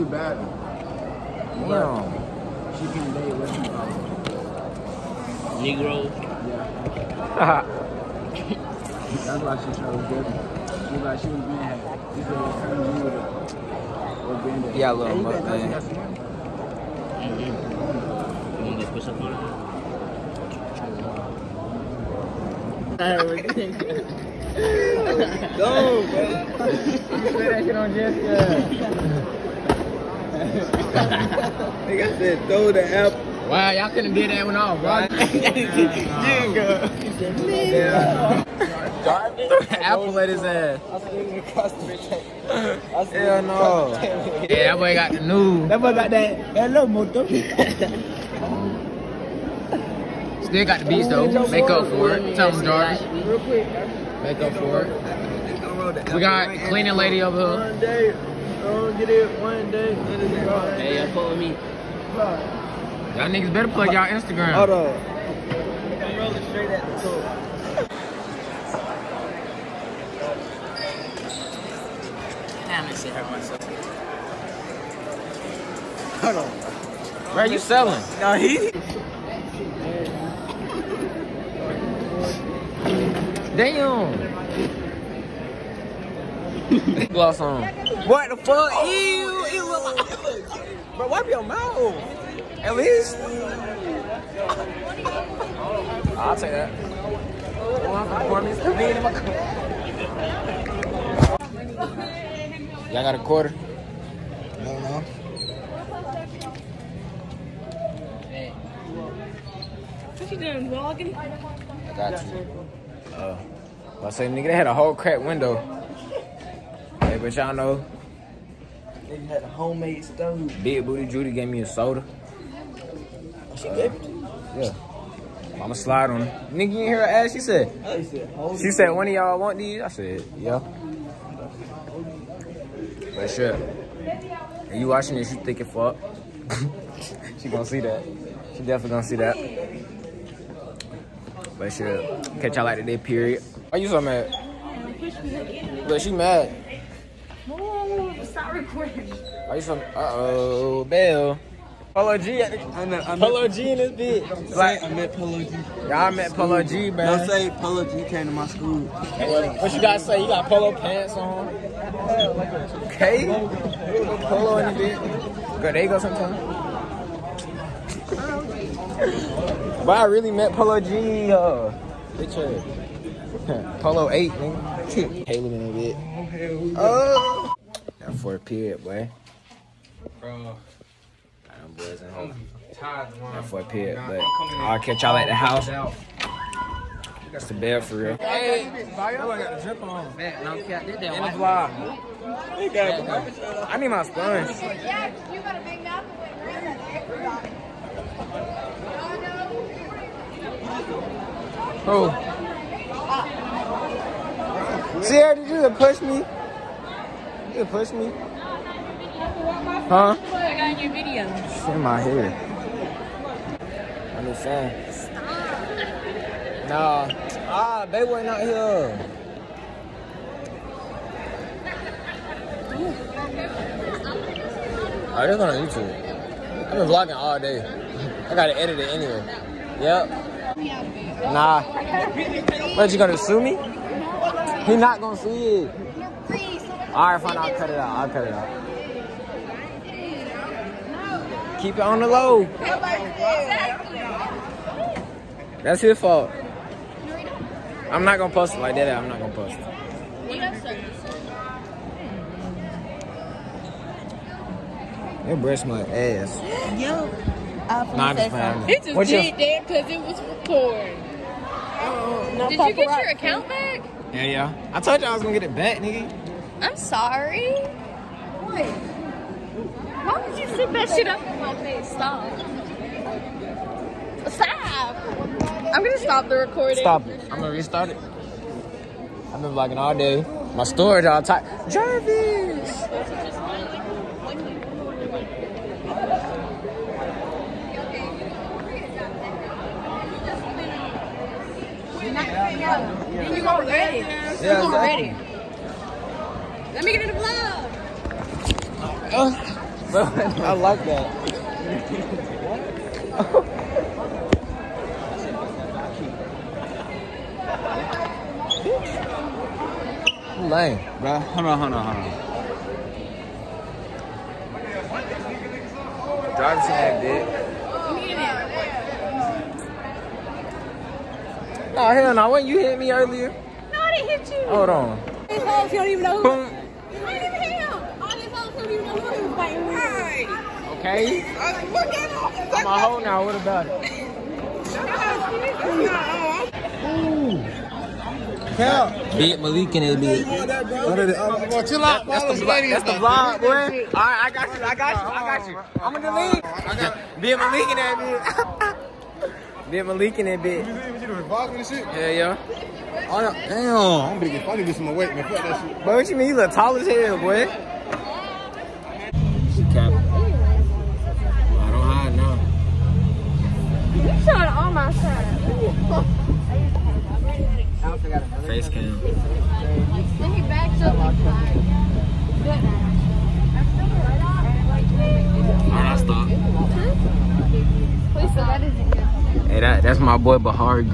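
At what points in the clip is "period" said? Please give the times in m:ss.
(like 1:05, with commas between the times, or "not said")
2:22, 2:58, 3:03.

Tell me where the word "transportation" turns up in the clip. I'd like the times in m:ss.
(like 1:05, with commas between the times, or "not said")
not said.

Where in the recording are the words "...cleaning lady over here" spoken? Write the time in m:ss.
0:56.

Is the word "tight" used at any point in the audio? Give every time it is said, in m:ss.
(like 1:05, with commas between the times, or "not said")
4:41.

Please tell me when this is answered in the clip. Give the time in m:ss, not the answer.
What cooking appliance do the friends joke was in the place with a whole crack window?
1:59.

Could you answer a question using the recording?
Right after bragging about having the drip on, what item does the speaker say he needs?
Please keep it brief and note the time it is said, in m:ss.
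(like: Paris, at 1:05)
sponge, at 3:14.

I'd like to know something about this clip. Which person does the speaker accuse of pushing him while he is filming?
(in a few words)
Sierra.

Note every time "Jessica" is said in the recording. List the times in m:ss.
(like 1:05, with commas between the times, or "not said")
0:27.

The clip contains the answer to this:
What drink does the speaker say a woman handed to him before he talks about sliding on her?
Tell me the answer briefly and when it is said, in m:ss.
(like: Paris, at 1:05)
soda, at 2:01.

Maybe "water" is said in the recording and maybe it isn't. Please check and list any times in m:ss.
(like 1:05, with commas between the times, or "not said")
not said.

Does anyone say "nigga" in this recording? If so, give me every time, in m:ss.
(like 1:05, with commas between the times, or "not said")
0:30, 1:03, 1:54, 2:06, 4:25.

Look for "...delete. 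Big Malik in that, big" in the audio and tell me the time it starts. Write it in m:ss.
5:46.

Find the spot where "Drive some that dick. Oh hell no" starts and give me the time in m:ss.
5:16.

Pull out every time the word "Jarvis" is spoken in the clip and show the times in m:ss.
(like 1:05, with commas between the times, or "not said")
0:52, 4:41.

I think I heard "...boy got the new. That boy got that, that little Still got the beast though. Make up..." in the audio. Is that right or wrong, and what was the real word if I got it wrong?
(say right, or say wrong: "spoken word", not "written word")
right.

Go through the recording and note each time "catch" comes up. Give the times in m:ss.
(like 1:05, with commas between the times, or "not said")
2:22, 3:04.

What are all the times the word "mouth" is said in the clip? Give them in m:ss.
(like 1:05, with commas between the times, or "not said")
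1:31, 3:15.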